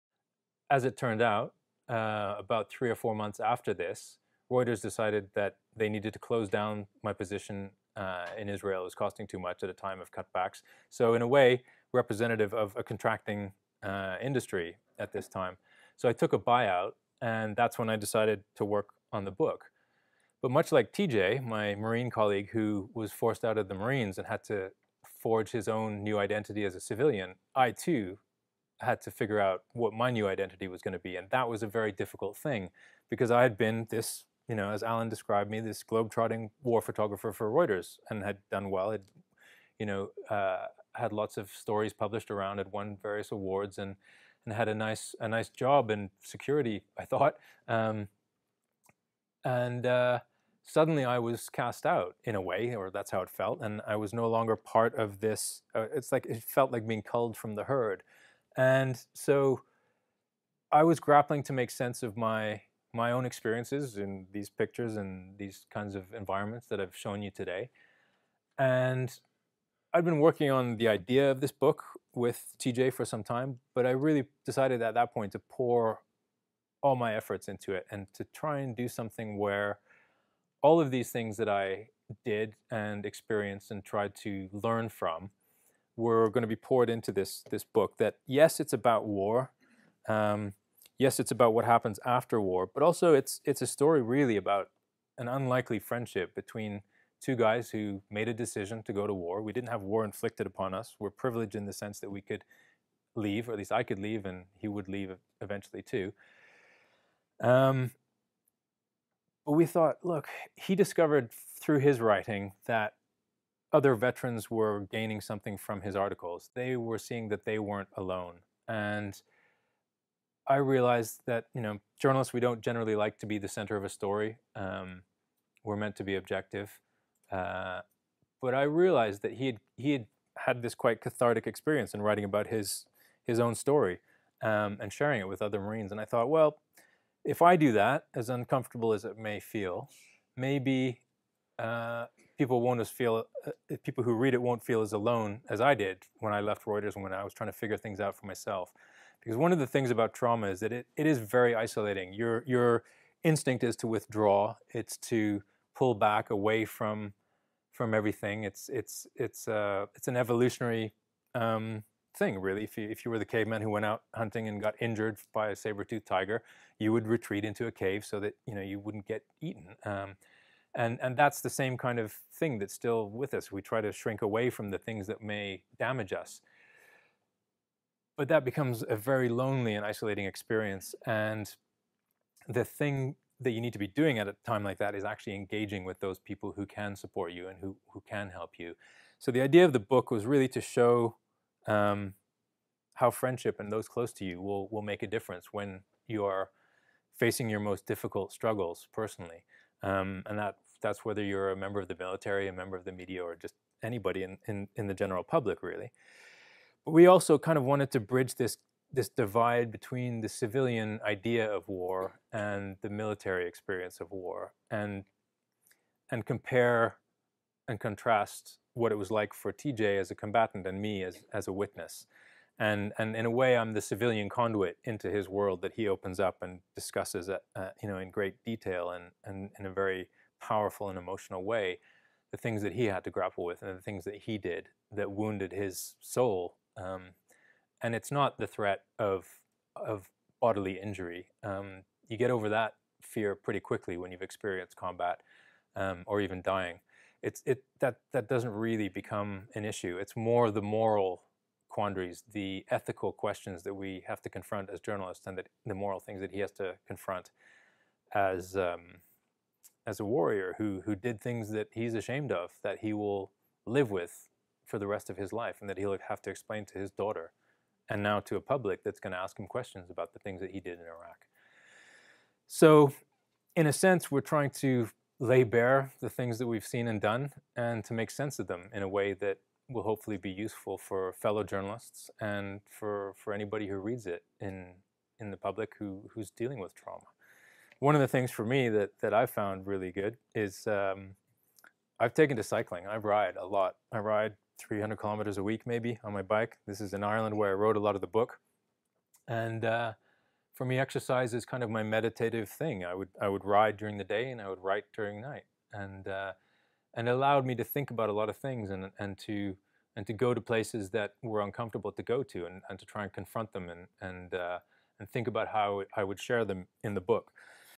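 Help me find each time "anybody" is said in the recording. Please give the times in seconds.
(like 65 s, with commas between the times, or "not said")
203 s, 283 s.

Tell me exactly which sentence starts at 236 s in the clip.
Um, and it's not the threat of of bodily injury.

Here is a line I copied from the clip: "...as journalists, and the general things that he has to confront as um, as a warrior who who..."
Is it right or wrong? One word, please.
wrong.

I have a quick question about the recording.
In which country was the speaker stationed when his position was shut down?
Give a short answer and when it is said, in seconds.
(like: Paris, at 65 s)
Israel, at 8 s.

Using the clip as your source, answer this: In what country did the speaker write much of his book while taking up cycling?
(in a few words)
Ireland.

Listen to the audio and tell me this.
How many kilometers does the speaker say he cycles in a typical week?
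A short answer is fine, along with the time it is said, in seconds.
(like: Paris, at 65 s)
300, at 294 s.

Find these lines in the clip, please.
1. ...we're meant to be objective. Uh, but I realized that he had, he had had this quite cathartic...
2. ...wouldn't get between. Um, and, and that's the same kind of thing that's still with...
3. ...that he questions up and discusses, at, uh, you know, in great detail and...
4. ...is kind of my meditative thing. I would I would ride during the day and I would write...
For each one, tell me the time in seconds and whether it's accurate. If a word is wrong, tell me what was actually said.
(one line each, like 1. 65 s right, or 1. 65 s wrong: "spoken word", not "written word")
1. 125 s right
2. 168 s wrong: "eaten", not "between"
3. 225 s wrong: "opens", not "questions"
4. 301 s right.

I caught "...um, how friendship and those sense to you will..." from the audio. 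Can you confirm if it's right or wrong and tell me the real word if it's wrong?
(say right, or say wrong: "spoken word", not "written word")
wrong: "close", not "sense".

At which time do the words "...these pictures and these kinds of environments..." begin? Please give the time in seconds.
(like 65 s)
64 s.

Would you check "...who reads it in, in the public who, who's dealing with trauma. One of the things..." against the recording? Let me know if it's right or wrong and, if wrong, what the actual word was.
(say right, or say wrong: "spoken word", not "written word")
right.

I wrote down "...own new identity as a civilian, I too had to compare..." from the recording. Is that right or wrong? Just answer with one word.
wrong.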